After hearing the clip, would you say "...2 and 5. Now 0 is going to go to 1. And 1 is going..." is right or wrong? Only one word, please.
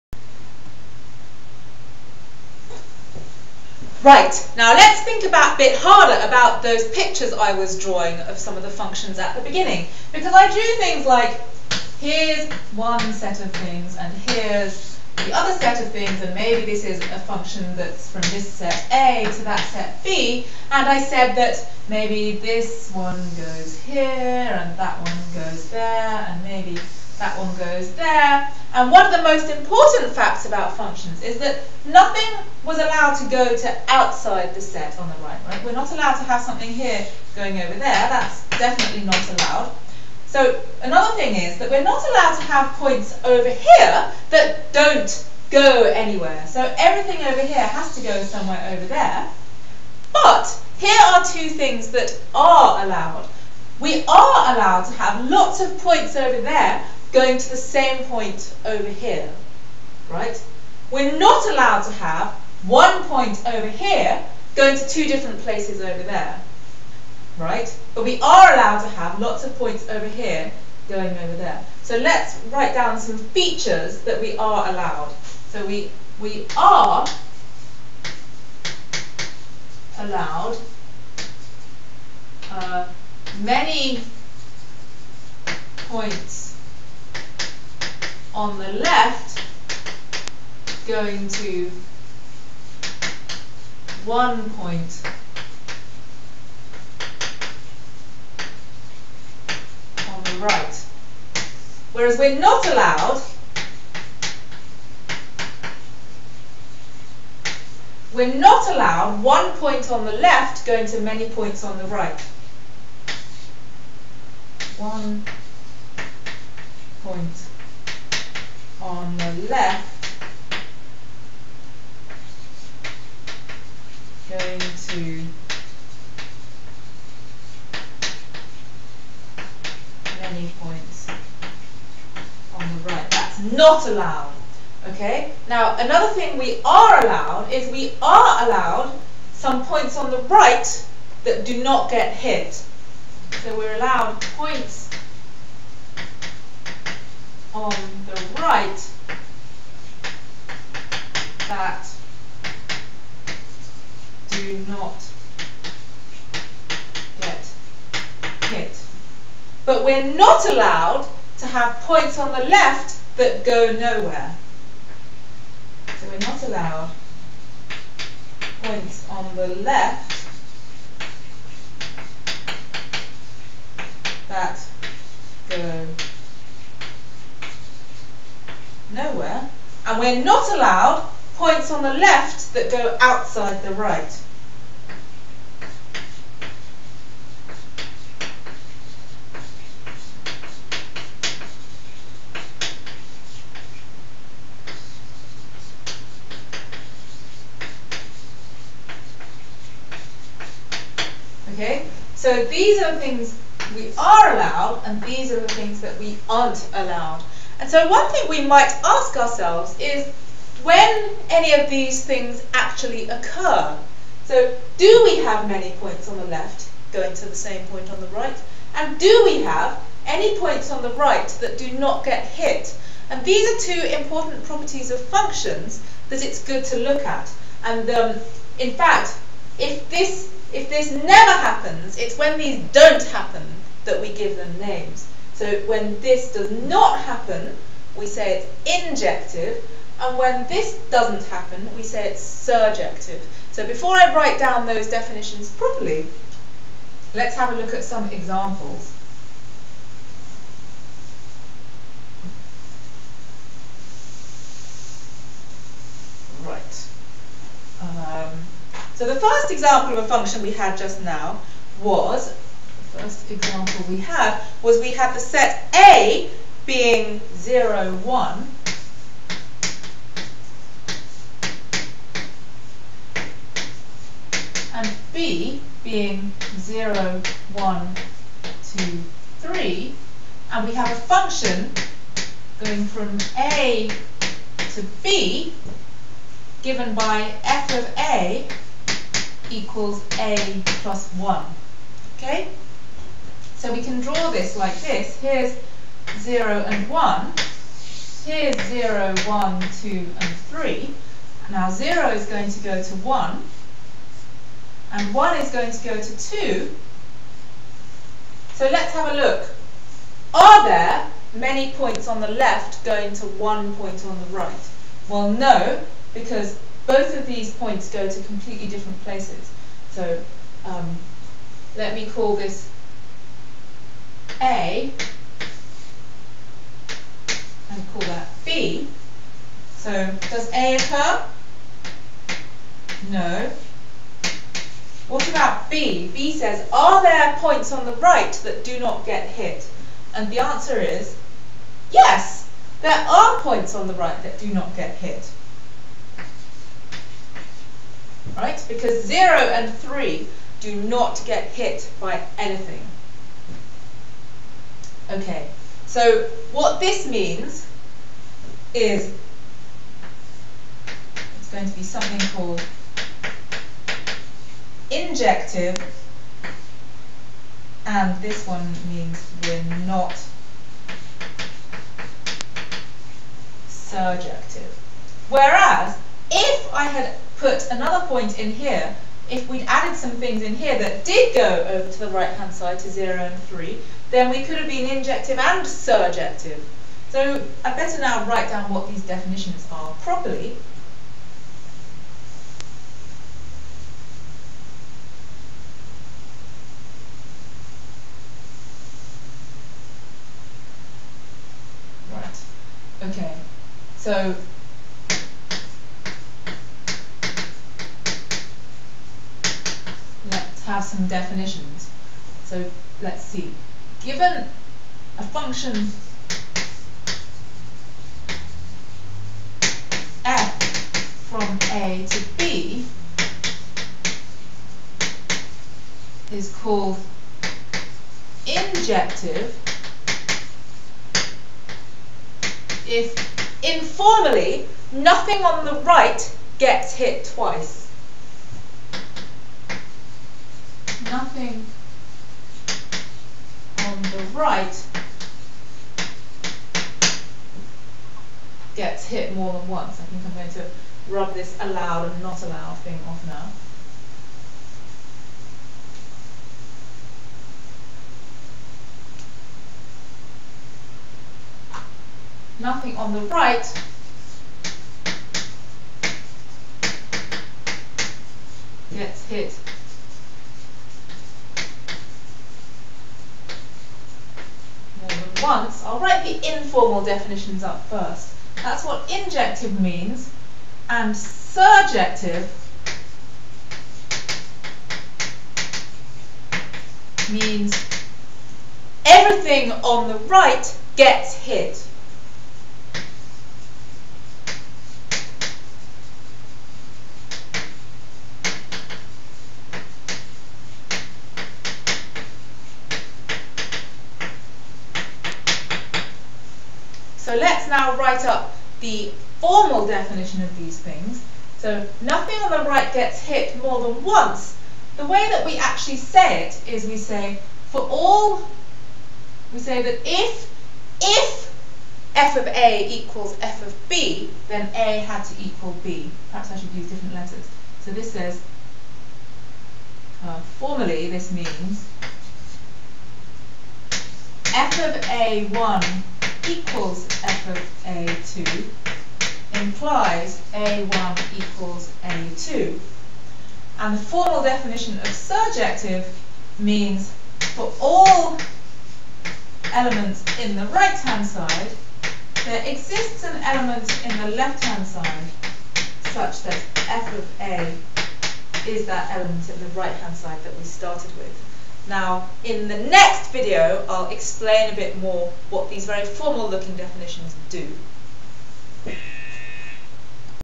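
wrong.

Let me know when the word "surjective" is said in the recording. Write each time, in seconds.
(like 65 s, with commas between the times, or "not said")
242 s, 373 s, 385 s, 481 s, 545 s.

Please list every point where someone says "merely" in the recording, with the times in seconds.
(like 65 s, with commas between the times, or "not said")
not said.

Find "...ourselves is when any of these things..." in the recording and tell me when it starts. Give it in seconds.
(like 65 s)
209 s.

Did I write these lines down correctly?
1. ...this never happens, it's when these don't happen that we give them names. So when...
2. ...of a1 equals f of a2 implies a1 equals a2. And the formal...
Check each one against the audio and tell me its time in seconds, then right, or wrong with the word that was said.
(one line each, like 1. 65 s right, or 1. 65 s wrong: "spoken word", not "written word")
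1. 230 s right
2. 534 s right.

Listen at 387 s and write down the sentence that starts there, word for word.
So I better now write down what these definitions are properly.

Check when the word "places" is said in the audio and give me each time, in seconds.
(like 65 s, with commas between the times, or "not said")
65 s, 319 s.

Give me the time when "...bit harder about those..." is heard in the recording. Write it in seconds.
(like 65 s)
5 s.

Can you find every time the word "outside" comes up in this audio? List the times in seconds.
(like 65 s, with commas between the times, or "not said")
33 s, 183 s.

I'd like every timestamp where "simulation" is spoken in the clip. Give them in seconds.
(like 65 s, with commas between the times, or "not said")
not said.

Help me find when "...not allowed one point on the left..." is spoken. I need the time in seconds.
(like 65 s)
108 s.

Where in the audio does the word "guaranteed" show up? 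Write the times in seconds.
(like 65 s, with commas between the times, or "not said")
not said.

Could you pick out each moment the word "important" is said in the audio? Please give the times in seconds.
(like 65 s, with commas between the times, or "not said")
29 s, 223 s.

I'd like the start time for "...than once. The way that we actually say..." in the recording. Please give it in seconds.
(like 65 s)
513 s.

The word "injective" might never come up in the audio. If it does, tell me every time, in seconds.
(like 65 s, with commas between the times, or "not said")
239 s, 364 s, 384 s, 428 s, 479 s.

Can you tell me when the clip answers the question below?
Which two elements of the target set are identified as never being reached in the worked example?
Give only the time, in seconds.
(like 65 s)
349 s.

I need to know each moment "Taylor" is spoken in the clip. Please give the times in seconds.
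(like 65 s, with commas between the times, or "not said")
not said.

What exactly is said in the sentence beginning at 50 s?
But here are two things that are allowed.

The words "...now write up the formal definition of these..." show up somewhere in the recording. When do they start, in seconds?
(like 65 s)
507 s.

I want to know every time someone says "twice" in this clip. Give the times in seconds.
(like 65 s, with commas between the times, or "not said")
437 s.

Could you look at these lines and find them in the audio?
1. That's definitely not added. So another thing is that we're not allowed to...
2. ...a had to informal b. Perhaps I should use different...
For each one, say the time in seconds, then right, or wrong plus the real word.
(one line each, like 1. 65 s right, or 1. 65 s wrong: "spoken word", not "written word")
1. 38 s wrong: "allowed", not "added"
2. 524 s wrong: "equal", not "informal".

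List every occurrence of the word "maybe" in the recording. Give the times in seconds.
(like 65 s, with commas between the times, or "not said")
16 s, 21 s, 26 s.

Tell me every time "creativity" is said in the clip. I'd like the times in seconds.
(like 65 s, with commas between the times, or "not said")
not said.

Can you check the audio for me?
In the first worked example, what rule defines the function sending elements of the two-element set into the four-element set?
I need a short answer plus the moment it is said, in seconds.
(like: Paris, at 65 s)
f(a) = a + 1, at 287 s.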